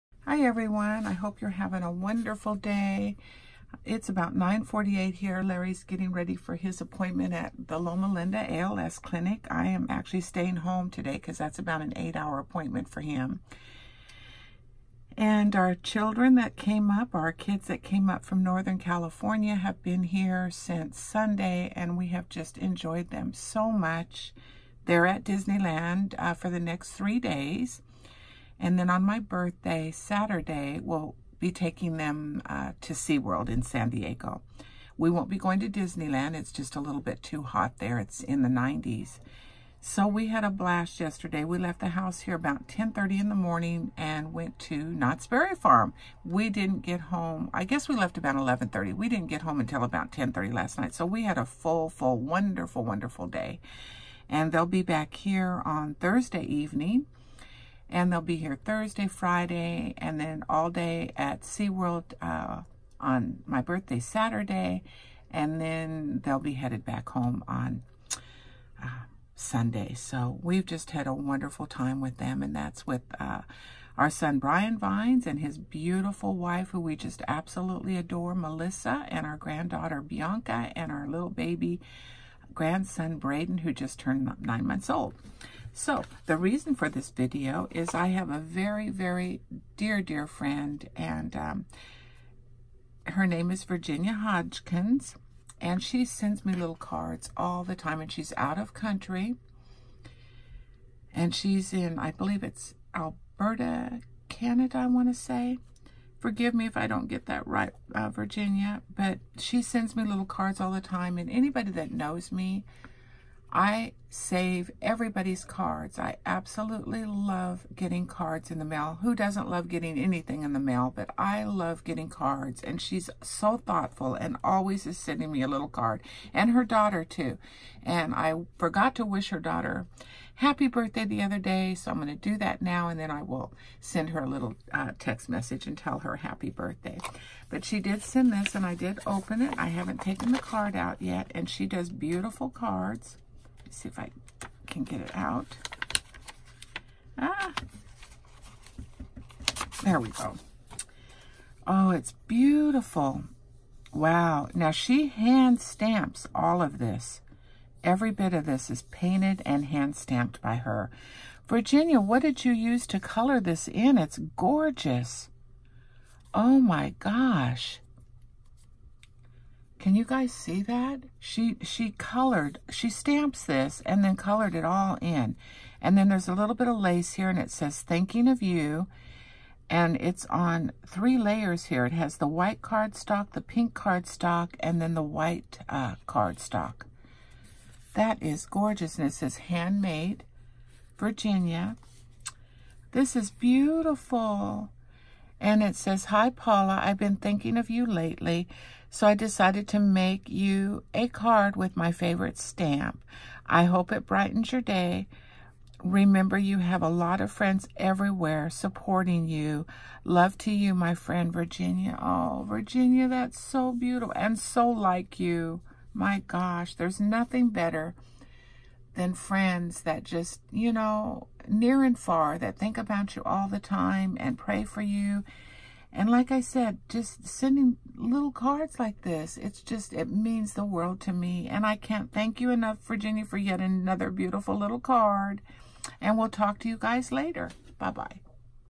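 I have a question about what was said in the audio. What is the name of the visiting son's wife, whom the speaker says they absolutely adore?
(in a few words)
Melissa.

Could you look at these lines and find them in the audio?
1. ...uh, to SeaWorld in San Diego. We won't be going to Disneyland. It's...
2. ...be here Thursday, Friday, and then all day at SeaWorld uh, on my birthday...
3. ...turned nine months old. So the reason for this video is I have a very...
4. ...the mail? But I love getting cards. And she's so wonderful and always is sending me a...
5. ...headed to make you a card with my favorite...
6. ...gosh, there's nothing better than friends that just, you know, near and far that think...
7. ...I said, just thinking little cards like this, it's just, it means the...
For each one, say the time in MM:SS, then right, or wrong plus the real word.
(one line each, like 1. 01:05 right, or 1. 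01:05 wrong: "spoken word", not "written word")
1. 00:32 right
2. 00:58 right
3. 01:23 right
4. 02:00 wrong: "thoughtful", not "wonderful"
5. 03:19 wrong: "decided", not "headed"
6. 03:36 right
7. 03:46 wrong: "sending", not "thinking".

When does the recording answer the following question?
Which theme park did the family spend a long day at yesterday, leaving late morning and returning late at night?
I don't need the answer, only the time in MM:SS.
00:44.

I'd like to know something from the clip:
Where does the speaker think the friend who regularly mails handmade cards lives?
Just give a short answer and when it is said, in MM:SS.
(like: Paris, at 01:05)
Alberta, Canada, at 01:42.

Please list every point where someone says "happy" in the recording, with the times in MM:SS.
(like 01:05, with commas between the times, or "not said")
02:10, 02:16.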